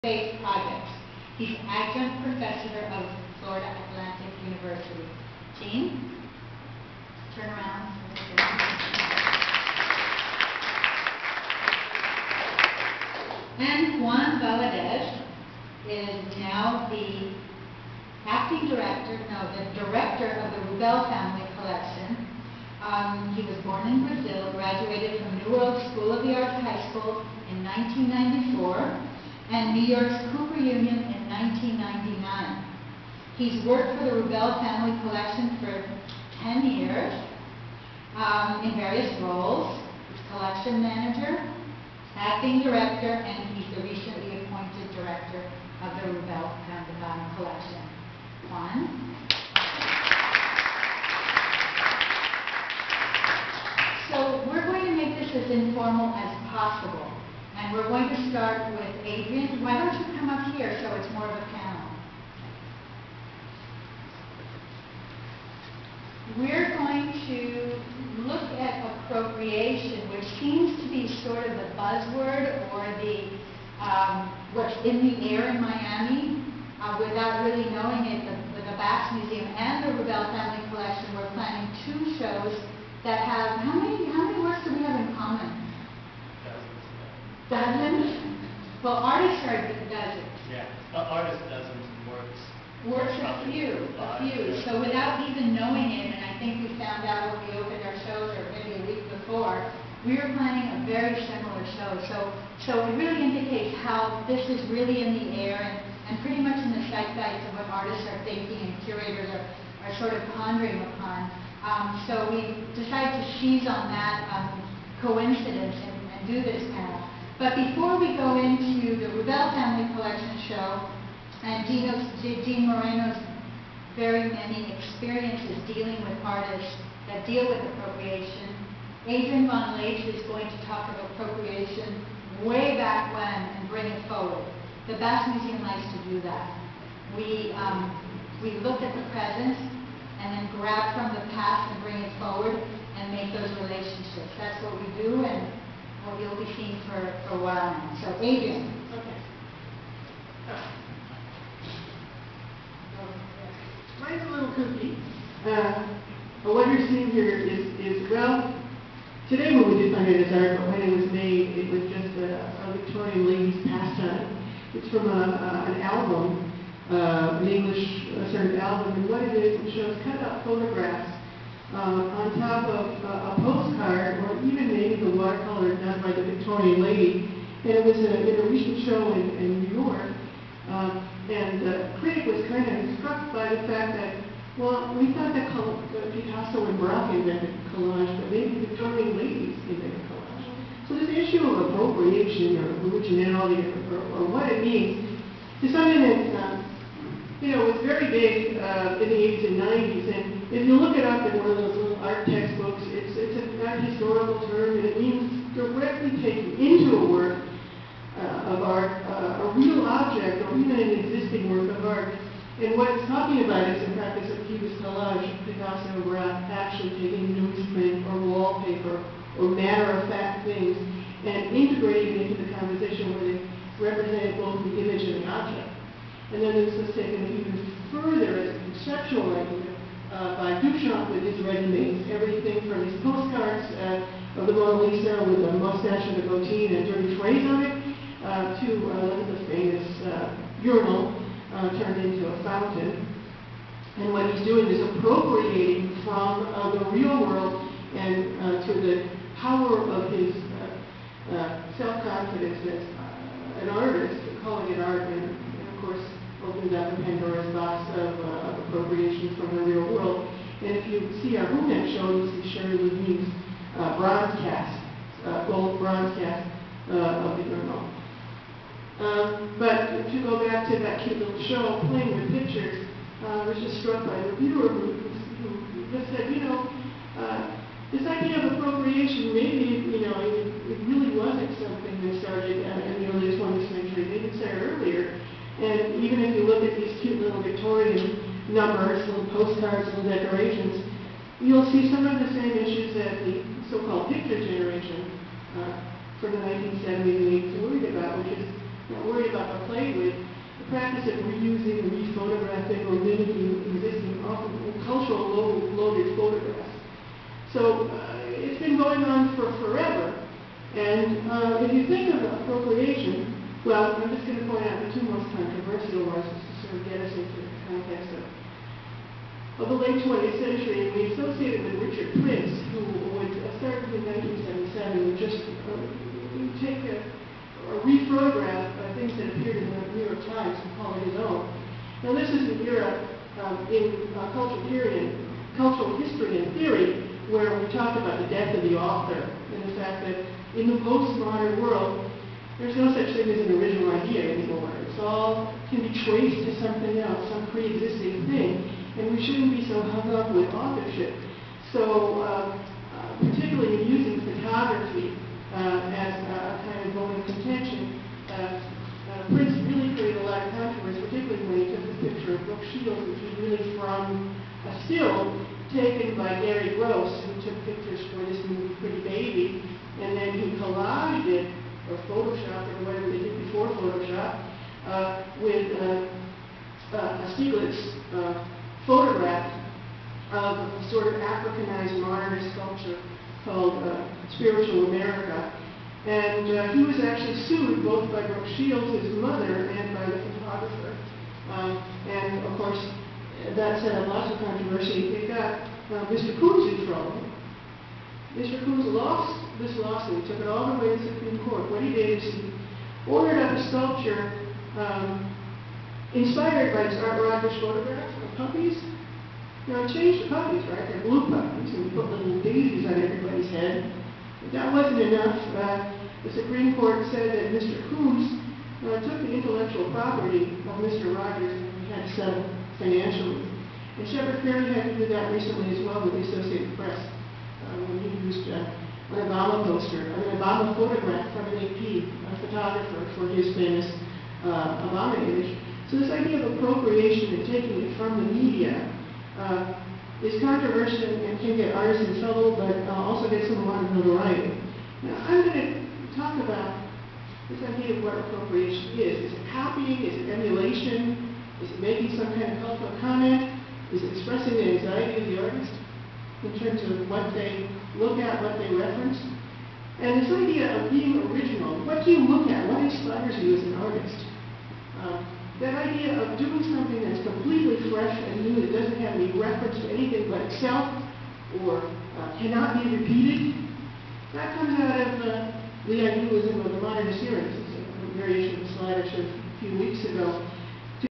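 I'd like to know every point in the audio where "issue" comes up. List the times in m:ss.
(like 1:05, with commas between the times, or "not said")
3:11, 4:52.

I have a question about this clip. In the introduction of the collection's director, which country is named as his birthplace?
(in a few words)
Brazil.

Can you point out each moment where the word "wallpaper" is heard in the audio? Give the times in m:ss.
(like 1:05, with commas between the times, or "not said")
3:38.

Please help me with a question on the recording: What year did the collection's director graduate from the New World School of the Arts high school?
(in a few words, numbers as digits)
1994.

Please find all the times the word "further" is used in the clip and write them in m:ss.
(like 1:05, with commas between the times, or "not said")
3:47.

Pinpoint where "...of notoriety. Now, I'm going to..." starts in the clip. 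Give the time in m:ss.
7:23.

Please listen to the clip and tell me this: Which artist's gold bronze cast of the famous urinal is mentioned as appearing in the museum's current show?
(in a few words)
Sherrie Levine.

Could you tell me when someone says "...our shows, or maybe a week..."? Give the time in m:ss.
1:37.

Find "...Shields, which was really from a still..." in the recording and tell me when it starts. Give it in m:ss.
6:02.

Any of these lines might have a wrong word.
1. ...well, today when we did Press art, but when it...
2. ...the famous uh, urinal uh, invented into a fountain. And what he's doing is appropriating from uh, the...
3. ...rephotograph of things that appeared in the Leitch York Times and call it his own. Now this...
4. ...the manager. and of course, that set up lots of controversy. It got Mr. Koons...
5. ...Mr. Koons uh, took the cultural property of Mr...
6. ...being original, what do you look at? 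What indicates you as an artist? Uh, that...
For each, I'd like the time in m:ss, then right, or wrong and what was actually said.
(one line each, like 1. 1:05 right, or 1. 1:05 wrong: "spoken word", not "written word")
1. 2:38 wrong: "Sunday", not "Press"
2. 3:59 wrong: "turned", not "invented"
3. 5:27 wrong: "New", not "Leitch"
4. 6:30 wrong: "photographer", not "manager"
5. 6:57 wrong: "intellectual", not "cultural"
6. 7:40 wrong: "inspires", not "indicates".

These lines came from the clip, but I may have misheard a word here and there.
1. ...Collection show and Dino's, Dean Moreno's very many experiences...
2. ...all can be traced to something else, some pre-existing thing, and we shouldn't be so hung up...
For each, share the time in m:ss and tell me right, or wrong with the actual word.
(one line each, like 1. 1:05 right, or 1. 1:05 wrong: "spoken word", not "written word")
1. 1:59 right
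2. 5:45 right.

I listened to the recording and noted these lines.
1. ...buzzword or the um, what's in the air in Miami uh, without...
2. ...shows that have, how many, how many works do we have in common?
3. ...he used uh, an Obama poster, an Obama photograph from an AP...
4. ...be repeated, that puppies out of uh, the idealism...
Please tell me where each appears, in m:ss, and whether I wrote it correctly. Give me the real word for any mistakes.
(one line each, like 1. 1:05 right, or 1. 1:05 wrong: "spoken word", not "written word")
1. 1:11 right
2. 1:22 right
3. 7:08 right
4. 7:52 wrong: "comes", not "puppies".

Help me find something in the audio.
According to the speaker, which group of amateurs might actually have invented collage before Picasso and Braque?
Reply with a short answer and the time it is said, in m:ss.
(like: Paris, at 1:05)
Victorian ladies, at 3:08.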